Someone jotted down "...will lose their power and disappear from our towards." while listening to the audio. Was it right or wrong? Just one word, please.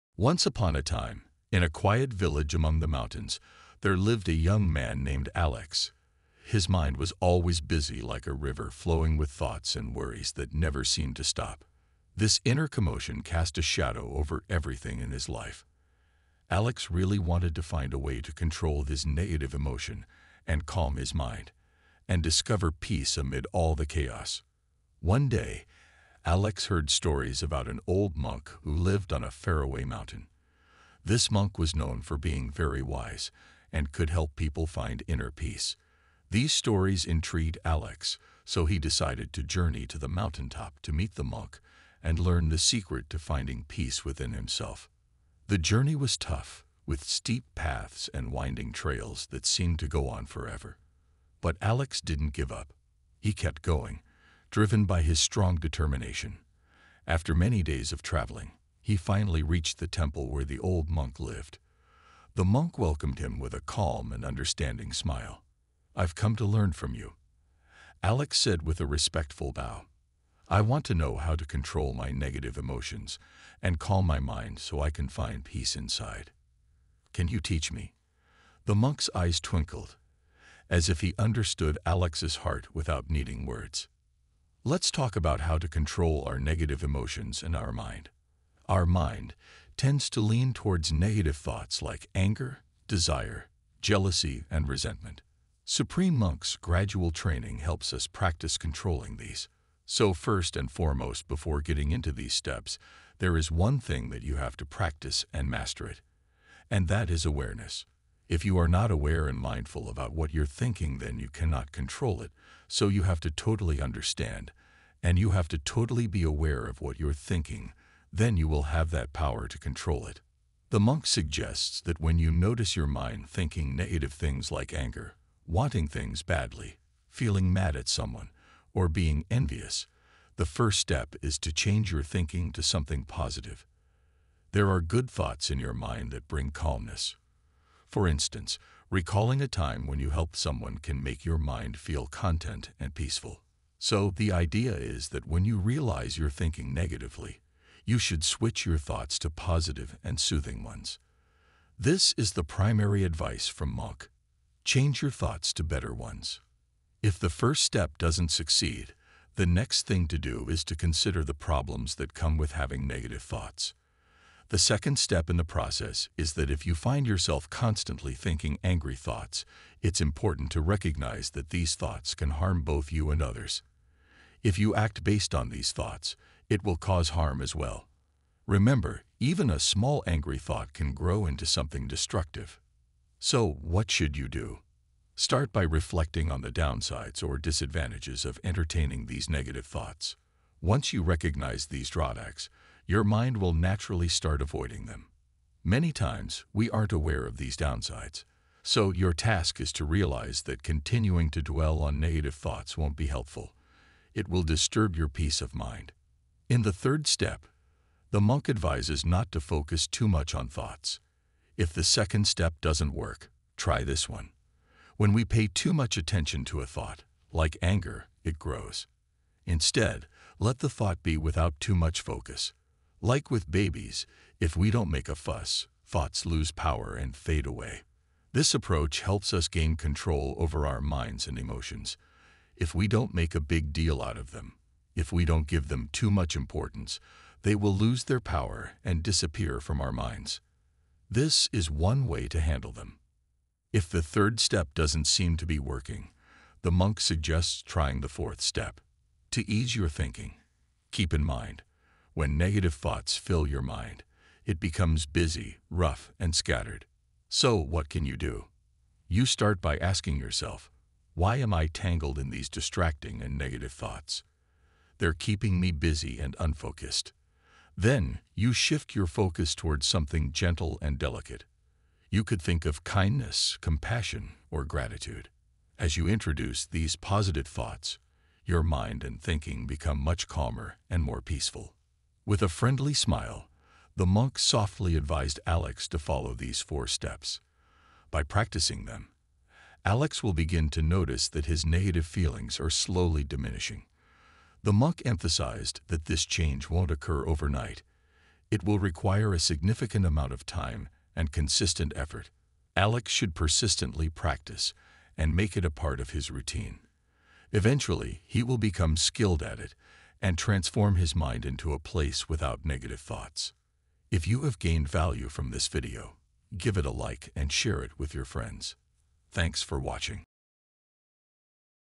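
wrong.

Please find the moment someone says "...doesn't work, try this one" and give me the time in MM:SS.
03:32.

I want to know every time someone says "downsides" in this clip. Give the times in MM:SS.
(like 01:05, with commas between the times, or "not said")
03:06, 03:17.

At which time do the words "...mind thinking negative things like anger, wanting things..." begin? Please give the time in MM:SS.
02:02.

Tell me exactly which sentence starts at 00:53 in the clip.
He kept going, driven by his strong determination.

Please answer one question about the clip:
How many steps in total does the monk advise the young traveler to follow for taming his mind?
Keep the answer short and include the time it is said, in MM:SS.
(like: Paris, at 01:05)
4, at 04:46.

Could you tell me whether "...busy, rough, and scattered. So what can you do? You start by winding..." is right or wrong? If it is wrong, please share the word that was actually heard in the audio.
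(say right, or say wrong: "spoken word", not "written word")
wrong: "asking", not "winding".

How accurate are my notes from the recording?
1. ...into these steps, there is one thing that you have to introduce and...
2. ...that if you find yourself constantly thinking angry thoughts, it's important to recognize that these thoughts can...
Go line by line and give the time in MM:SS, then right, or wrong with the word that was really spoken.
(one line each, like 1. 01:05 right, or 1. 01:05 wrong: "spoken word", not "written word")
1. 01:41 wrong: "practice", not "introduce"
2. 02:46 right.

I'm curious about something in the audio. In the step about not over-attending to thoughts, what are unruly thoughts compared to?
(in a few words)
Babies.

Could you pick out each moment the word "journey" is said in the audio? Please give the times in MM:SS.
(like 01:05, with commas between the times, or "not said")
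00:39, 00:45.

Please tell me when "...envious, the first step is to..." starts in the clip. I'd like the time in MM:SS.
02:09.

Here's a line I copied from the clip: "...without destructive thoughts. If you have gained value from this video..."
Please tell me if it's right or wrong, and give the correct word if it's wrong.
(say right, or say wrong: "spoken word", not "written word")
wrong: "negative", not "destructive".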